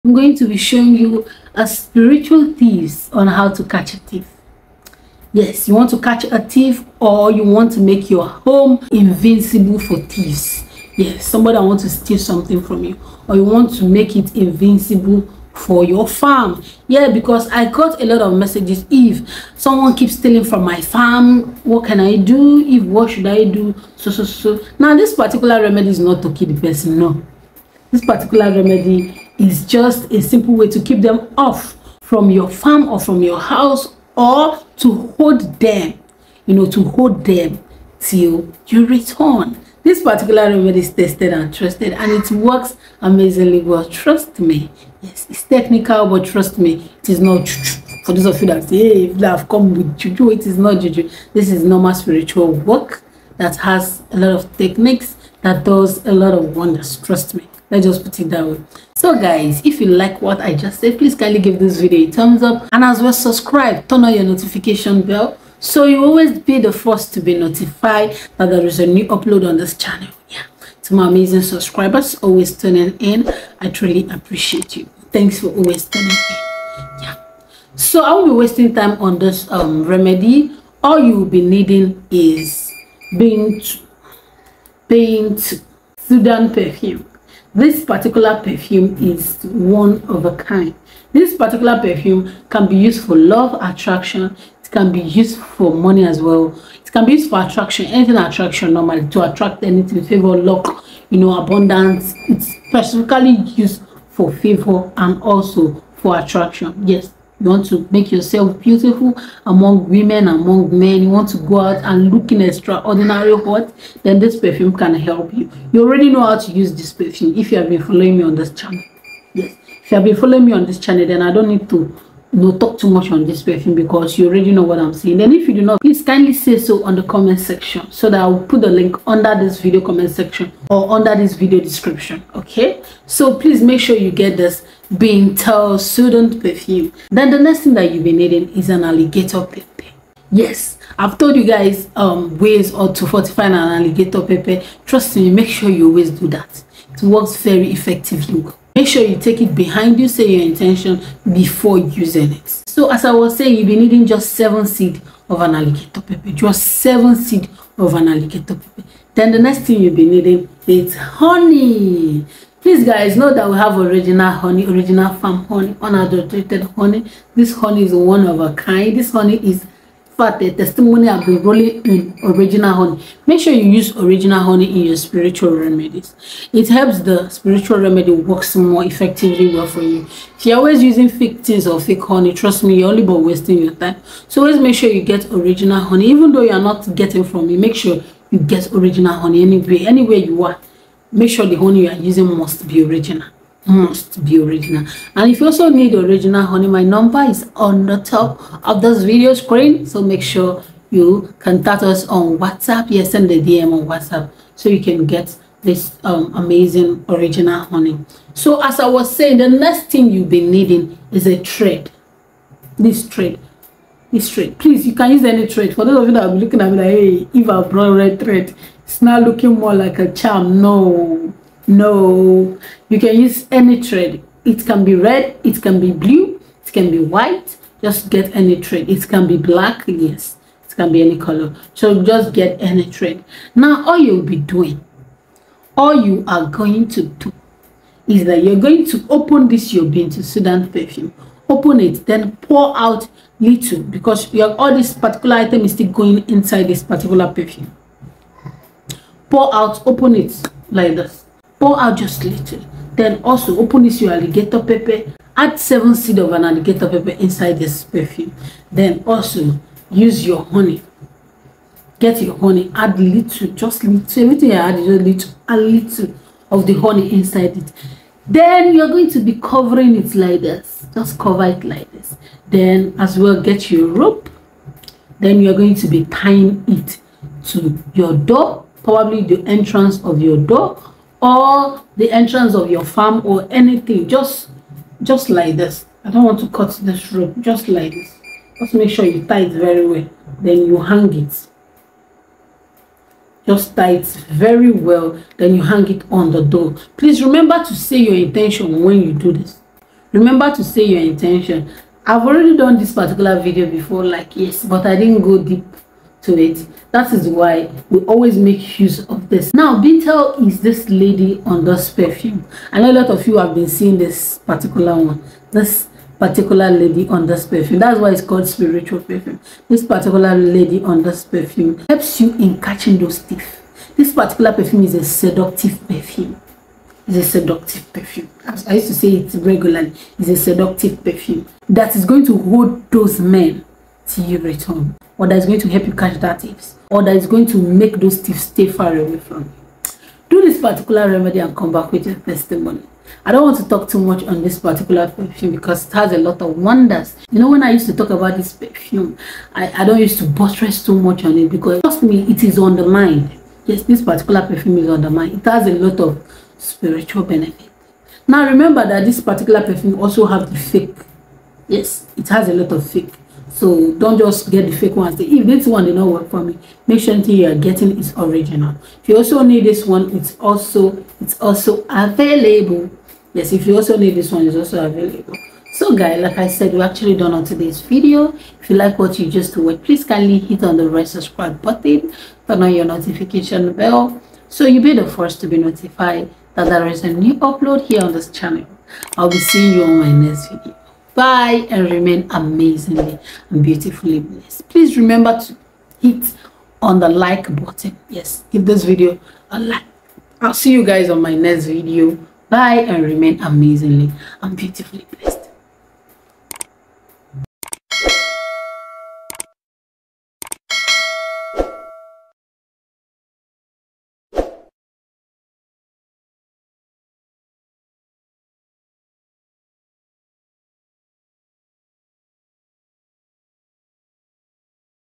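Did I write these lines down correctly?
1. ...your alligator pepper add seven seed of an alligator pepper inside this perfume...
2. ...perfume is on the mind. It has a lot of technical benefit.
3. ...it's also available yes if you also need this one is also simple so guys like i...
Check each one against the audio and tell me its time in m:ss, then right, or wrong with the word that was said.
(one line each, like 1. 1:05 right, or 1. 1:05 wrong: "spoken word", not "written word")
1. 4:14 right
2. 5:54 wrong: "spiritual", not "technical"
3. 6:11 wrong: "available", not "simple".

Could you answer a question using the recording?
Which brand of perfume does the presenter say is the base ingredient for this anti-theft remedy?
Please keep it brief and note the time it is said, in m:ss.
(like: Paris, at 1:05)
Bint El Sudan, at 3:59.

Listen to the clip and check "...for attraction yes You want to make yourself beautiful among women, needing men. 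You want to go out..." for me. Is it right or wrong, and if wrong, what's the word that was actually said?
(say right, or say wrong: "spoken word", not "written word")
wrong: "among", not "needing".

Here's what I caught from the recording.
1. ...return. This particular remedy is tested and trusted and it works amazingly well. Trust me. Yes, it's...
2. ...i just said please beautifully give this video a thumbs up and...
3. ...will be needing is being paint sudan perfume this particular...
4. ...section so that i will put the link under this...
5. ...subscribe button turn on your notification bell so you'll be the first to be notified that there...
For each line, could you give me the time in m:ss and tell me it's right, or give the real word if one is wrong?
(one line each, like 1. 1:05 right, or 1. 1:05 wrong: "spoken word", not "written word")
1. 0:38 right
2. 1:00 wrong: "kindly", not "beautifully"
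3. 1:21 right
4. 2:07 right
5. 6:21 right.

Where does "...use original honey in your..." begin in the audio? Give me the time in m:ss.
2:53.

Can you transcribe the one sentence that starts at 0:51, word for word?
This is normal spiritual work that has a lot of techniques that does a lot of wonders.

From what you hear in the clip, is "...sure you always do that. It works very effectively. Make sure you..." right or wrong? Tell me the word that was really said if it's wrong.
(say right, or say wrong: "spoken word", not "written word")
right.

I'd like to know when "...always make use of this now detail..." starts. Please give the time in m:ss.
5:08.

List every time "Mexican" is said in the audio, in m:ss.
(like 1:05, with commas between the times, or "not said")
not said.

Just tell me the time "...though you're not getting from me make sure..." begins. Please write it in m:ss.
3:06.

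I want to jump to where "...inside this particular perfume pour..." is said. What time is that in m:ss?
4:06.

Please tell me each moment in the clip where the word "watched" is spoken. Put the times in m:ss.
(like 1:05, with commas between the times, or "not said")
6:19.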